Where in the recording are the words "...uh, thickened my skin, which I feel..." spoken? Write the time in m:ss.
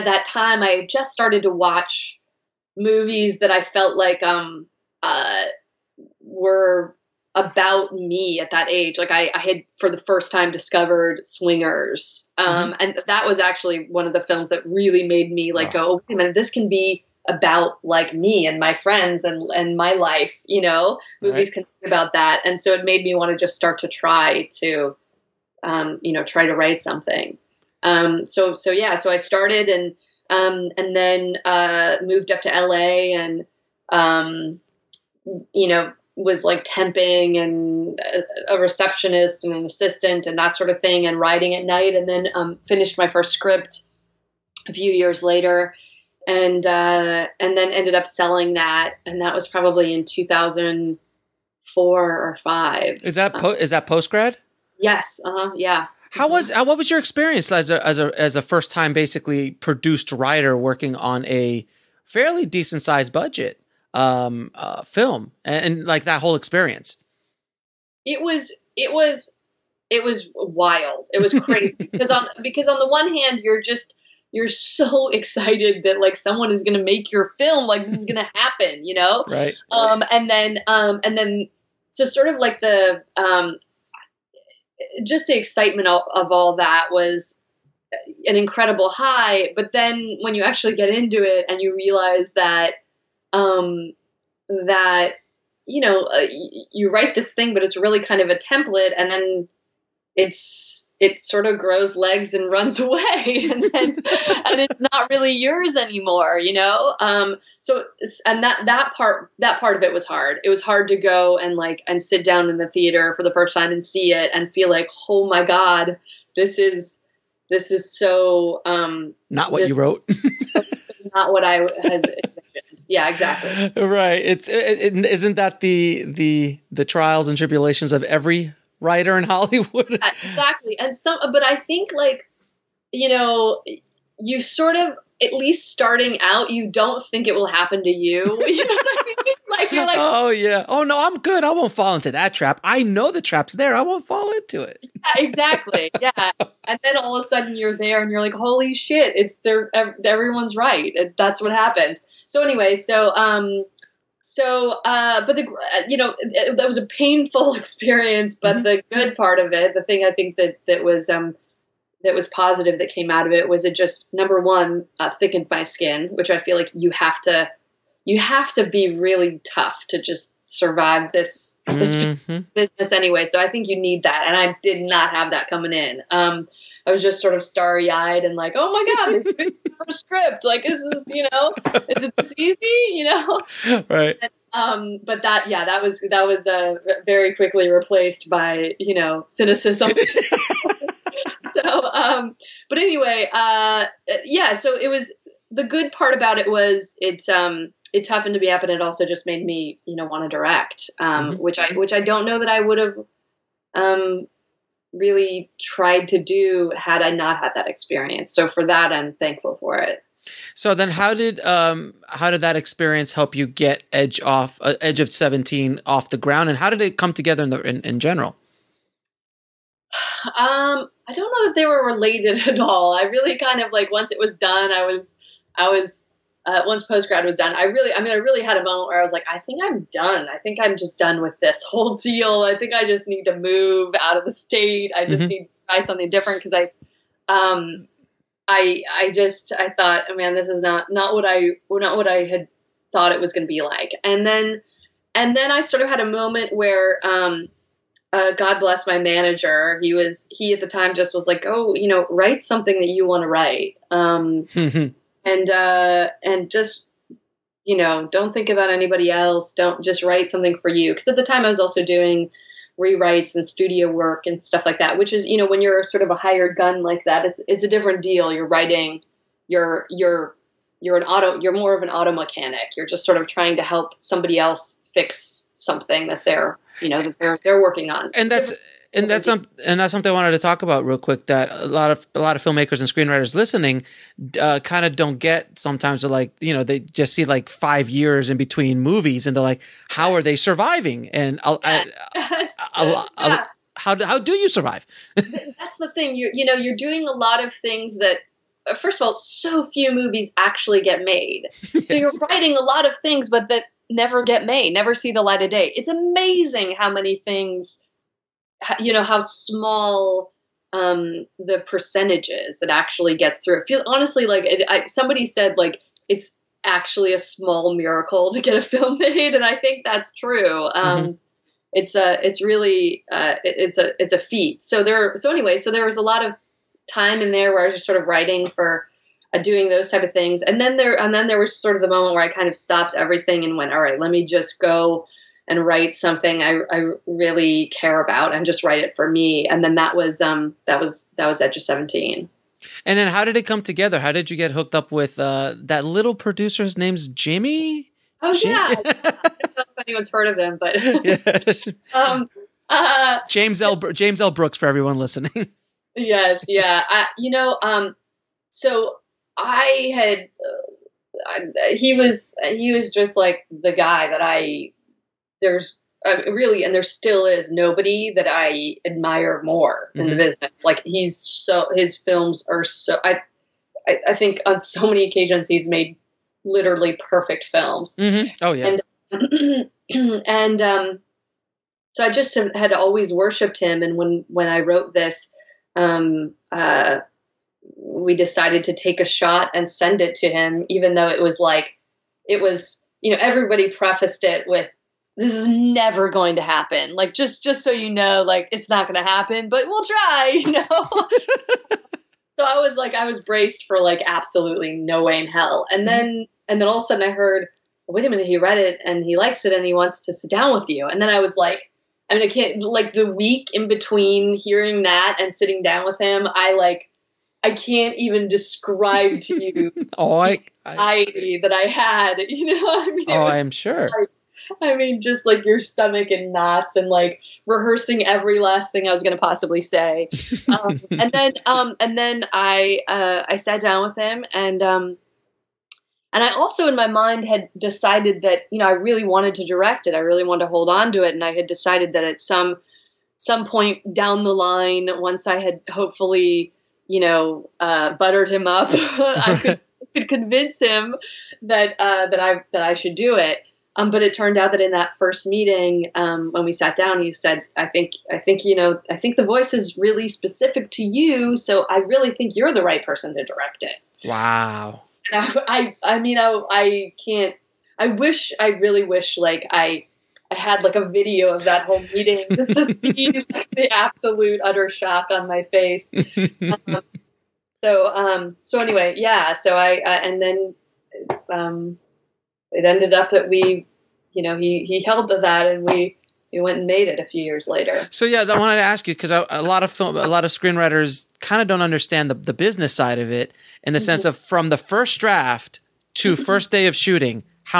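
2:44.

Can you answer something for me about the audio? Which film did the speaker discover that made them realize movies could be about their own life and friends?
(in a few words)
Swingers.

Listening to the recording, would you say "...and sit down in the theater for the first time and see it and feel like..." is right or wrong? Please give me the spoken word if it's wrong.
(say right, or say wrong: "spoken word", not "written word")
right.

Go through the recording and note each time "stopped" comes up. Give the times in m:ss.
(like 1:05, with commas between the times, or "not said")
5:32.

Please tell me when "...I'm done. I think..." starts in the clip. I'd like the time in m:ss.
3:49.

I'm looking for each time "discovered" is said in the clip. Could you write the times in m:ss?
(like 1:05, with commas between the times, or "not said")
0:10.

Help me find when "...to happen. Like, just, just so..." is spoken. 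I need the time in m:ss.
6:36.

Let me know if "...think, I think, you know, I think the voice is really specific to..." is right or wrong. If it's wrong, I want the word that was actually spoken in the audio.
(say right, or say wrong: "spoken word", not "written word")
right.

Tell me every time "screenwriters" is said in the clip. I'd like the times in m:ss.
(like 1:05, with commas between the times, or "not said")
4:42, 8:10.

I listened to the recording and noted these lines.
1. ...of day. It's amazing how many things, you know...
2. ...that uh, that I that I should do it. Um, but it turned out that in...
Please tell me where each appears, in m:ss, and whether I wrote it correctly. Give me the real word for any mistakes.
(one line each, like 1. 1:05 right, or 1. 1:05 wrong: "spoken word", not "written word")
1. 5:05 right
2. 7:31 right.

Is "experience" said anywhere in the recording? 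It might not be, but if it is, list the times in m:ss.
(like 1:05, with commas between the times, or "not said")
0:56, 1:06, 2:37, 3:27, 3:32.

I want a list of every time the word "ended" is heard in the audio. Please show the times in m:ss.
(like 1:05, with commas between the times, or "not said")
0:47, 8:02.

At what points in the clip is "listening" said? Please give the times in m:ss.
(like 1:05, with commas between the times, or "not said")
4:43, 5:54.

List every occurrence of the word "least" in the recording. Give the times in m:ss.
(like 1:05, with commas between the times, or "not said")
2:15.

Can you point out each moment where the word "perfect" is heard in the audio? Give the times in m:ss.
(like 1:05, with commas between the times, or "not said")
6:17.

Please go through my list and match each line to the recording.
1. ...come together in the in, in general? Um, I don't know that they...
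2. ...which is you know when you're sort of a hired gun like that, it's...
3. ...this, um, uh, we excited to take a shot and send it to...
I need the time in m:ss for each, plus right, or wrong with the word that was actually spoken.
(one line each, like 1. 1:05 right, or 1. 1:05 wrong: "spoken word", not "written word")
1. 3:36 right
2. 4:24 right
3. 6:24 wrong: "decided", not "excited".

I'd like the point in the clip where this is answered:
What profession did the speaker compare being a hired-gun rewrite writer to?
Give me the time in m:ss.
4:31.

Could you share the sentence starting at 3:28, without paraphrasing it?
So for that, I'm thankful for it.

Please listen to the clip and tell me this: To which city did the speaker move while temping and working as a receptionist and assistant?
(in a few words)
LA.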